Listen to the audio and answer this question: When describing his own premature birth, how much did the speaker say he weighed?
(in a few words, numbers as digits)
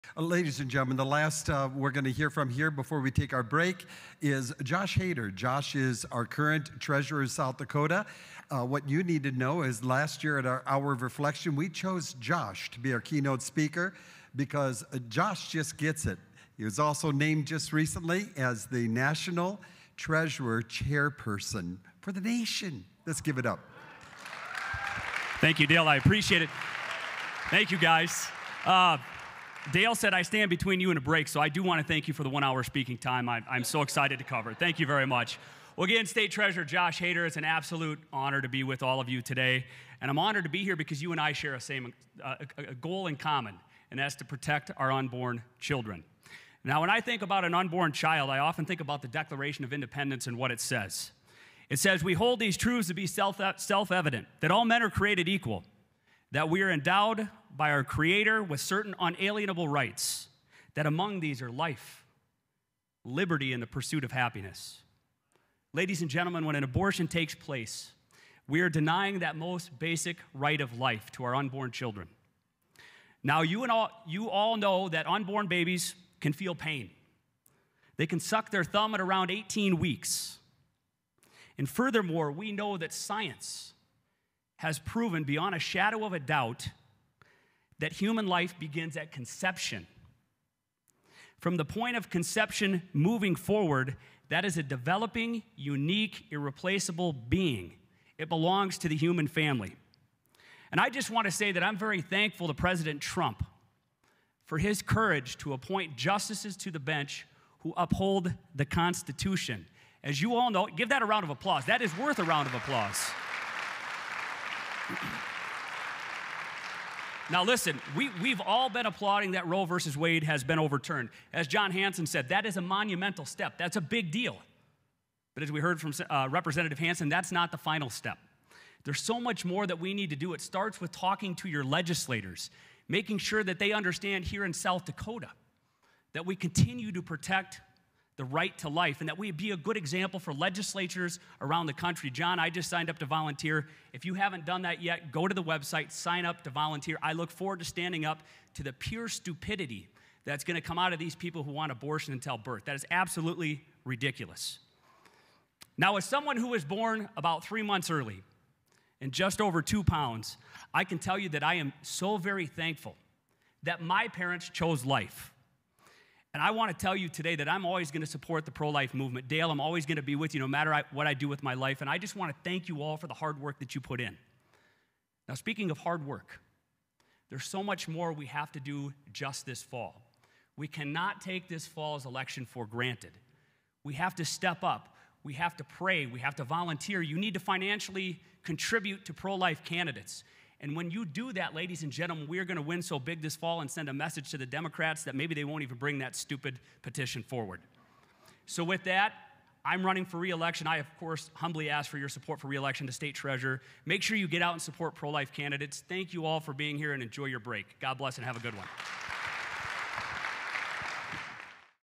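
just over 2 pounds.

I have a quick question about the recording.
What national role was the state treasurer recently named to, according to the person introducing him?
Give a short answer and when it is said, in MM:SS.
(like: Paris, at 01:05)
National Treasurer Chairperson, at 00:18.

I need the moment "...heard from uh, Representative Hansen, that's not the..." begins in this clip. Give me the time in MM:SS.
02:05.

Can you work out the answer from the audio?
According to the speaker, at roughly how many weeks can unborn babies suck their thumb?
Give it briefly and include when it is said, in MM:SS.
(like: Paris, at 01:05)
18 weeks, at 01:19.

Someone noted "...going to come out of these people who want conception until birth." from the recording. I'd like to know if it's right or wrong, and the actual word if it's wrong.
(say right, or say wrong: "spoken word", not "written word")
wrong: "abortion", not "conception".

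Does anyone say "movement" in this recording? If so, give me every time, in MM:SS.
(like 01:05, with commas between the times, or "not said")
02:48.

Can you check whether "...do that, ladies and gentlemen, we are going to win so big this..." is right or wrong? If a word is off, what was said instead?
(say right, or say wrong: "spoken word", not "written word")
right.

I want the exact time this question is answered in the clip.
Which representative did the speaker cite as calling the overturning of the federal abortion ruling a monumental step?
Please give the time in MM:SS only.
02:01.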